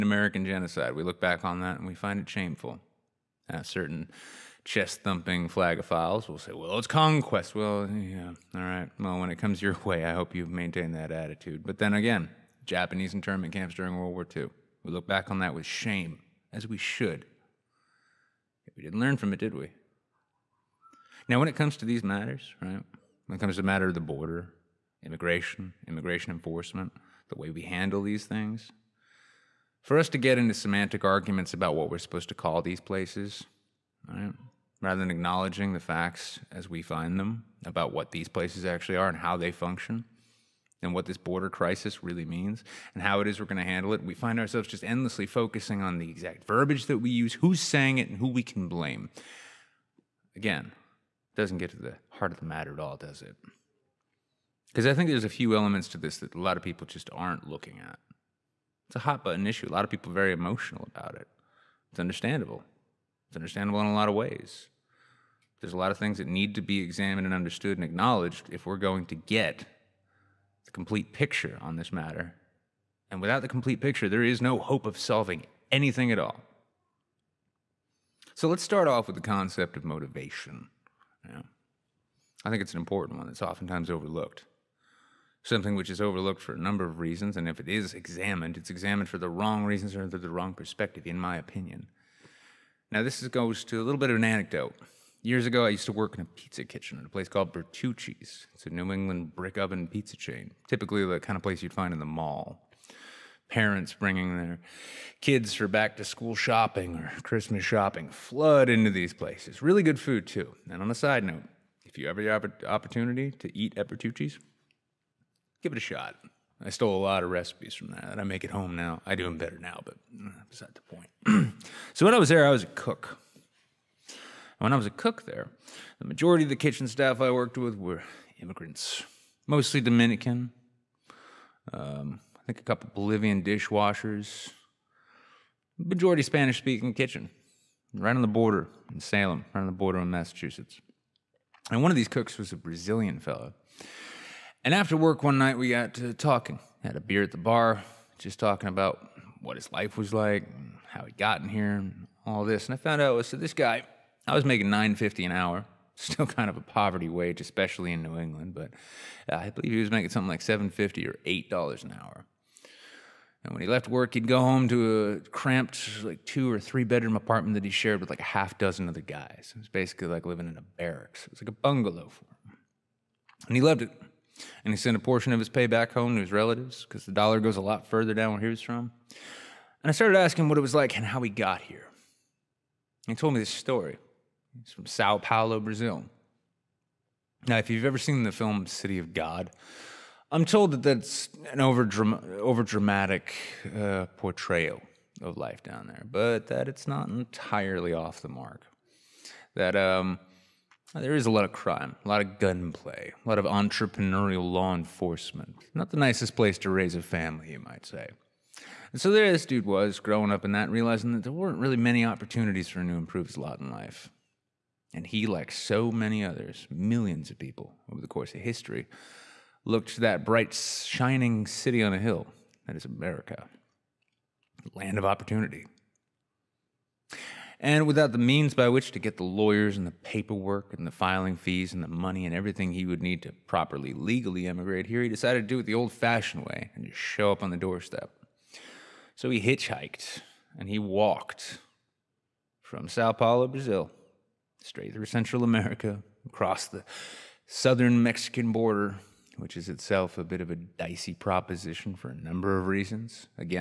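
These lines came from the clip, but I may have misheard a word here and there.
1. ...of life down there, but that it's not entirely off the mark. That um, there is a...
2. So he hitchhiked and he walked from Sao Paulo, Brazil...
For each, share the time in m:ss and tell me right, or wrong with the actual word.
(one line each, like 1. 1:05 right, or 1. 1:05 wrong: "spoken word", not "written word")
1. 3:15 right
2. 3:59 right.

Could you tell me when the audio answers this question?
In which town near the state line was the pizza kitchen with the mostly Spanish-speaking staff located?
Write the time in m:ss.
2:18.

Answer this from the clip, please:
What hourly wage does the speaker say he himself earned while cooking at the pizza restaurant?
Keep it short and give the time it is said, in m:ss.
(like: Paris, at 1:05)
$9.50, at 2:34.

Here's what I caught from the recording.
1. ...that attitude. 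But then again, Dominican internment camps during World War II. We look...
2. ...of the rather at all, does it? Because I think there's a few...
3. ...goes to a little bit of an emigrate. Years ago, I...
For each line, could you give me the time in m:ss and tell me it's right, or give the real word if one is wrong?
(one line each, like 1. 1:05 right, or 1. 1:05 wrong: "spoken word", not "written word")
1. 0:10 wrong: "Japanese", not "Dominican"
2. 0:52 wrong: "matter", not "rather"
3. 1:33 wrong: "anecdote", not "emigrate".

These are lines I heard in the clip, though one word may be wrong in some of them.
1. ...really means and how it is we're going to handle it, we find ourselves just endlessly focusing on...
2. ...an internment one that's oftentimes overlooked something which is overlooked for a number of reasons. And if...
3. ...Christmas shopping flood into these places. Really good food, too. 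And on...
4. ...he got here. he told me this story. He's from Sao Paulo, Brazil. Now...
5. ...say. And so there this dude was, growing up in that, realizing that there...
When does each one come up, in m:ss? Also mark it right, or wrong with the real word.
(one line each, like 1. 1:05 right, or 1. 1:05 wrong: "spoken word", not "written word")
1. 0:42 right
2. 1:22 wrong: "important", not "internment"
3. 1:47 right
4. 3:01 right
5. 3:27 right.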